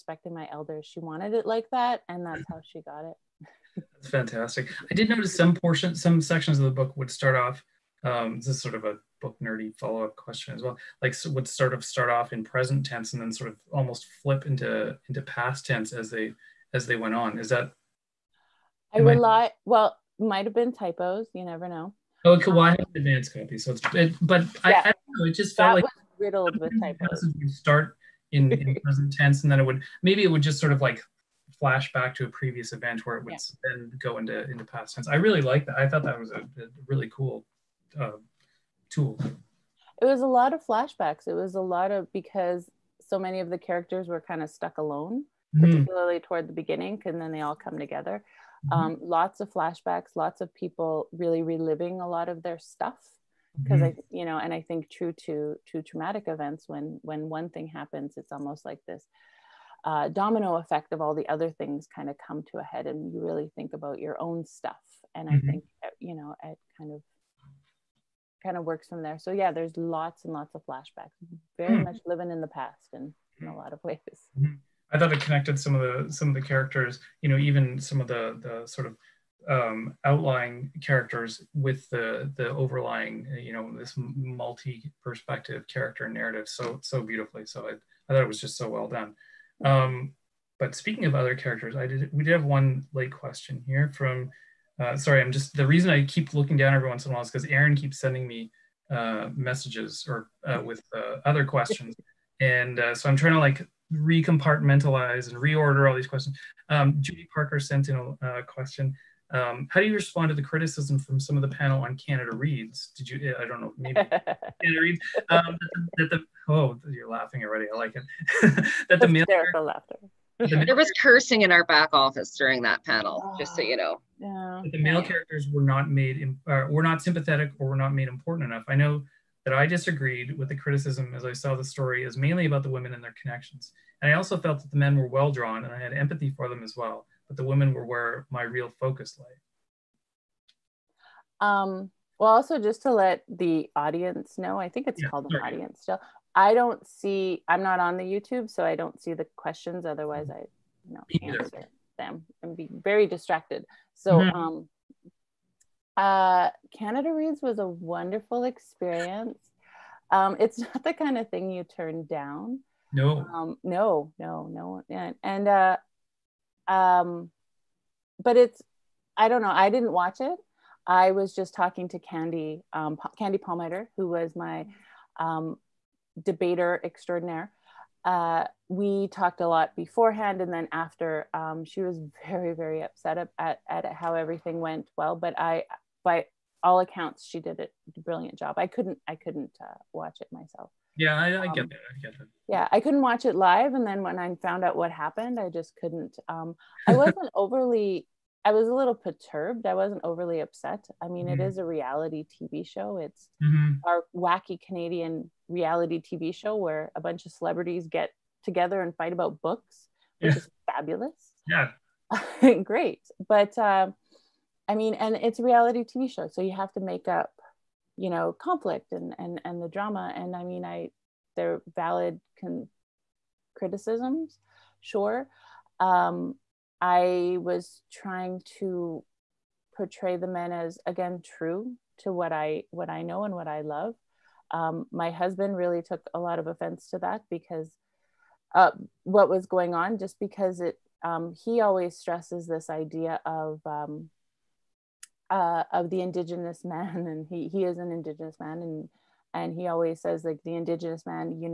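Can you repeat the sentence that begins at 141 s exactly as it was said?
Um, well, also just to let the audience know, I think it's yeah, called sorry.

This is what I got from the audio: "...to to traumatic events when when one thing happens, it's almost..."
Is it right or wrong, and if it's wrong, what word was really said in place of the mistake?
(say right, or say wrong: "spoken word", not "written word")
right.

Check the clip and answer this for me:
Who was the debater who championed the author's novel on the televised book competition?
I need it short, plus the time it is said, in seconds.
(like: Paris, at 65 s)
Candy Palmater, at 173 s.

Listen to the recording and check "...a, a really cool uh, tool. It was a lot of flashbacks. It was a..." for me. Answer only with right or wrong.
right.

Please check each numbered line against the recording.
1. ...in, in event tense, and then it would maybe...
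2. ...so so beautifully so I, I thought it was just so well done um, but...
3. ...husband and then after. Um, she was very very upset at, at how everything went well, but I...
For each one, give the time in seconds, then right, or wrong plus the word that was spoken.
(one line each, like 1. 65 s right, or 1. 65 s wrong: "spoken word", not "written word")
1. 28 s wrong: "present", not "event"
2. 86 s right
3. 179 s wrong: "beforehand", not "husband".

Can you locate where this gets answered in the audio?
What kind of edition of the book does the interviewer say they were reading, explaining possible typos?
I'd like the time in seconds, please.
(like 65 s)
22 s.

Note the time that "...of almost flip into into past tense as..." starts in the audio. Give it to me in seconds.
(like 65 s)
13 s.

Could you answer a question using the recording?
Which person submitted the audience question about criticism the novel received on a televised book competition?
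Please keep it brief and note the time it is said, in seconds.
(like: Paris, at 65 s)
Judy Parker, at 106 s.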